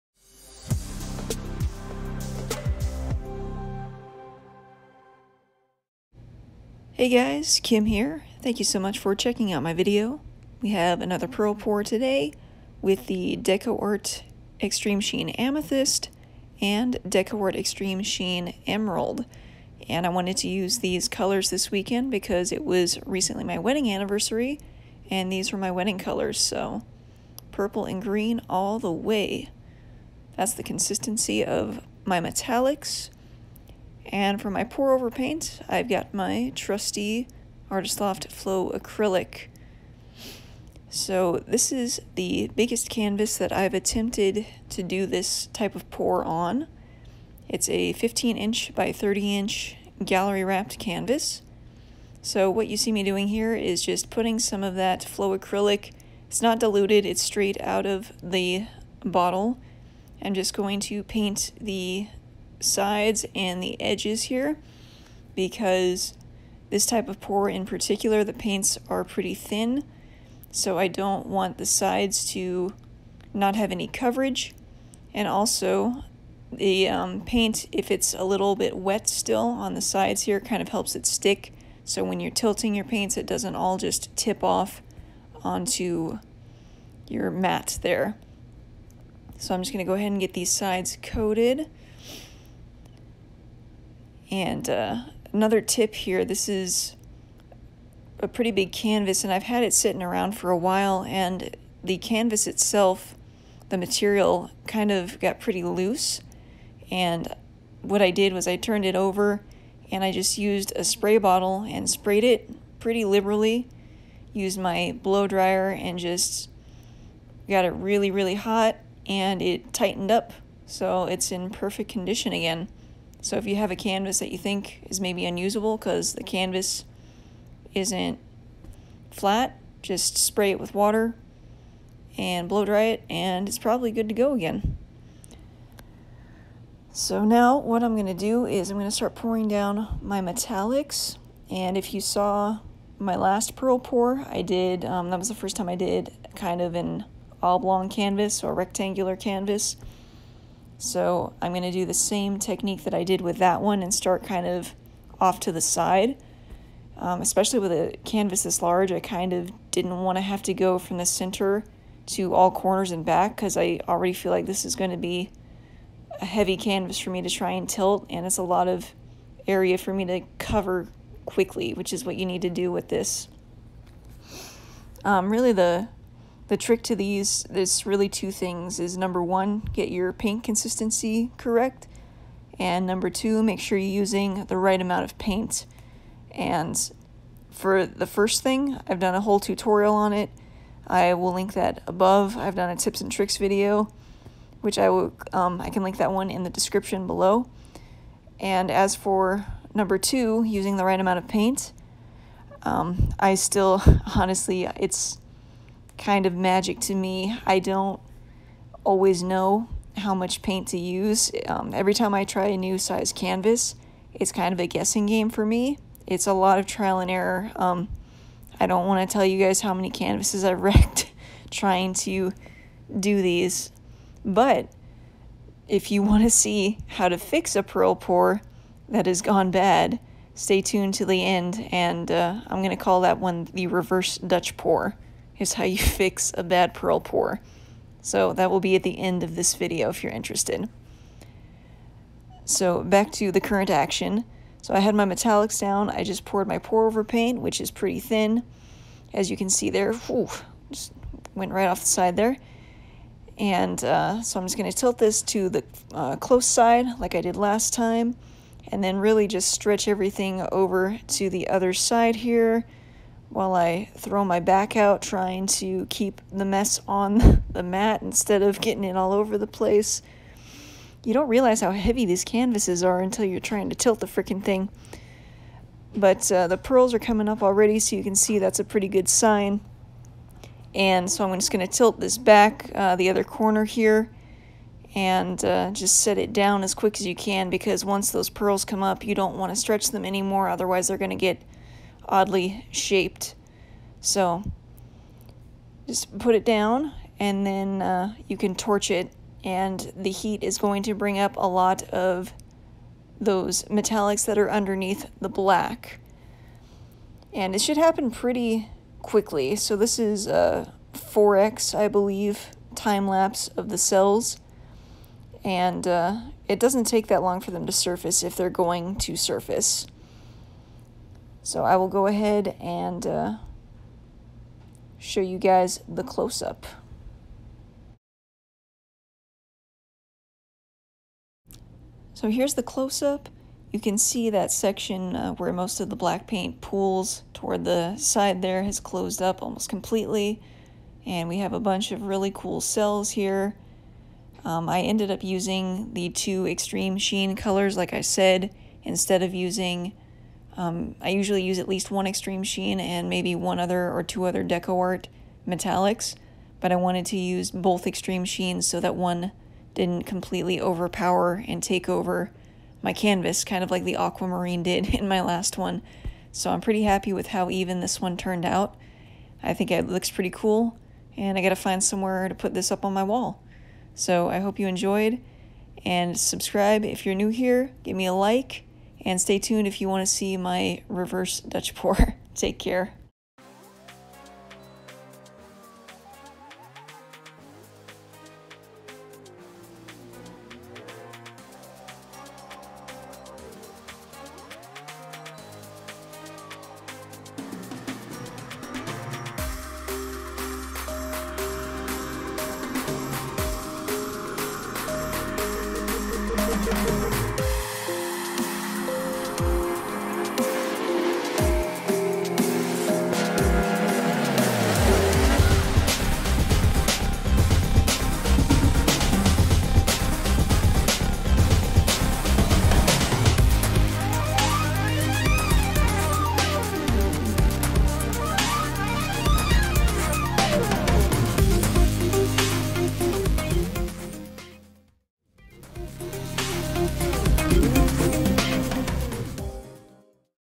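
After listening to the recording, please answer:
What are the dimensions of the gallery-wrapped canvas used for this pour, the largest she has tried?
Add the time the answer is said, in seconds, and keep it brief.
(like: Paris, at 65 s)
15 inch by 30 inch, at 47 s.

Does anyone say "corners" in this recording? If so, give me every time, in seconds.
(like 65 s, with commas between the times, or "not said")
162 s, 283 s.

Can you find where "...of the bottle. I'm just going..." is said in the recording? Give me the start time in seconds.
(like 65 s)
57 s.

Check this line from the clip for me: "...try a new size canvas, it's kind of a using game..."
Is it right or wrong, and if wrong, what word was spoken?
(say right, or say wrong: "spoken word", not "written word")
wrong: "guessing", not "using".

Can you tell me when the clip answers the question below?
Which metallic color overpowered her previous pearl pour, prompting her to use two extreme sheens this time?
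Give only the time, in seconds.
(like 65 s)
363 s.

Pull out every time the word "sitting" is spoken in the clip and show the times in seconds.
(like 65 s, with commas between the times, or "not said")
99 s.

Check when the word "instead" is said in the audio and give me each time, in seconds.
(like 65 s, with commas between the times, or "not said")
268 s, 348 s.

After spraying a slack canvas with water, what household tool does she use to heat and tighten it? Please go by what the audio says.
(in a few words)
blow dryer.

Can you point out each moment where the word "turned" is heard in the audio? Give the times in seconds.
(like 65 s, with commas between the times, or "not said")
108 s, 368 s.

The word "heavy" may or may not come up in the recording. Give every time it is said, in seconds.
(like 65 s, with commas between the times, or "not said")
166 s, 271 s.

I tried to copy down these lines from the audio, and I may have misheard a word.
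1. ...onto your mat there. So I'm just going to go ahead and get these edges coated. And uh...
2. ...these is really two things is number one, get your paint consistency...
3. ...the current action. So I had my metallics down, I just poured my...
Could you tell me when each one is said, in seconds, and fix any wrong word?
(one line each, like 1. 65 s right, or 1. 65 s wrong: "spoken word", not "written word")
1. 85 s wrong: "sides", not "edges"
2. 176 s right
3. 243 s right.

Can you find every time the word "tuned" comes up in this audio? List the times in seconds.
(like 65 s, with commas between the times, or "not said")
230 s, 379 s.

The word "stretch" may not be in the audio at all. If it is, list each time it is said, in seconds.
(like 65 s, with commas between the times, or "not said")
259 s, 289 s.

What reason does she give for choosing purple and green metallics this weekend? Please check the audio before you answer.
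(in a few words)
wedding colors.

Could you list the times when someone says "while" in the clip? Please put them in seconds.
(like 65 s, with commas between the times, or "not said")
100 s, 263 s.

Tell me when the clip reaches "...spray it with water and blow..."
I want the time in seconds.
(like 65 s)
130 s.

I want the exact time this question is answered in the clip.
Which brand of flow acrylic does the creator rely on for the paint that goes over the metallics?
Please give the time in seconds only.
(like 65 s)
37 s.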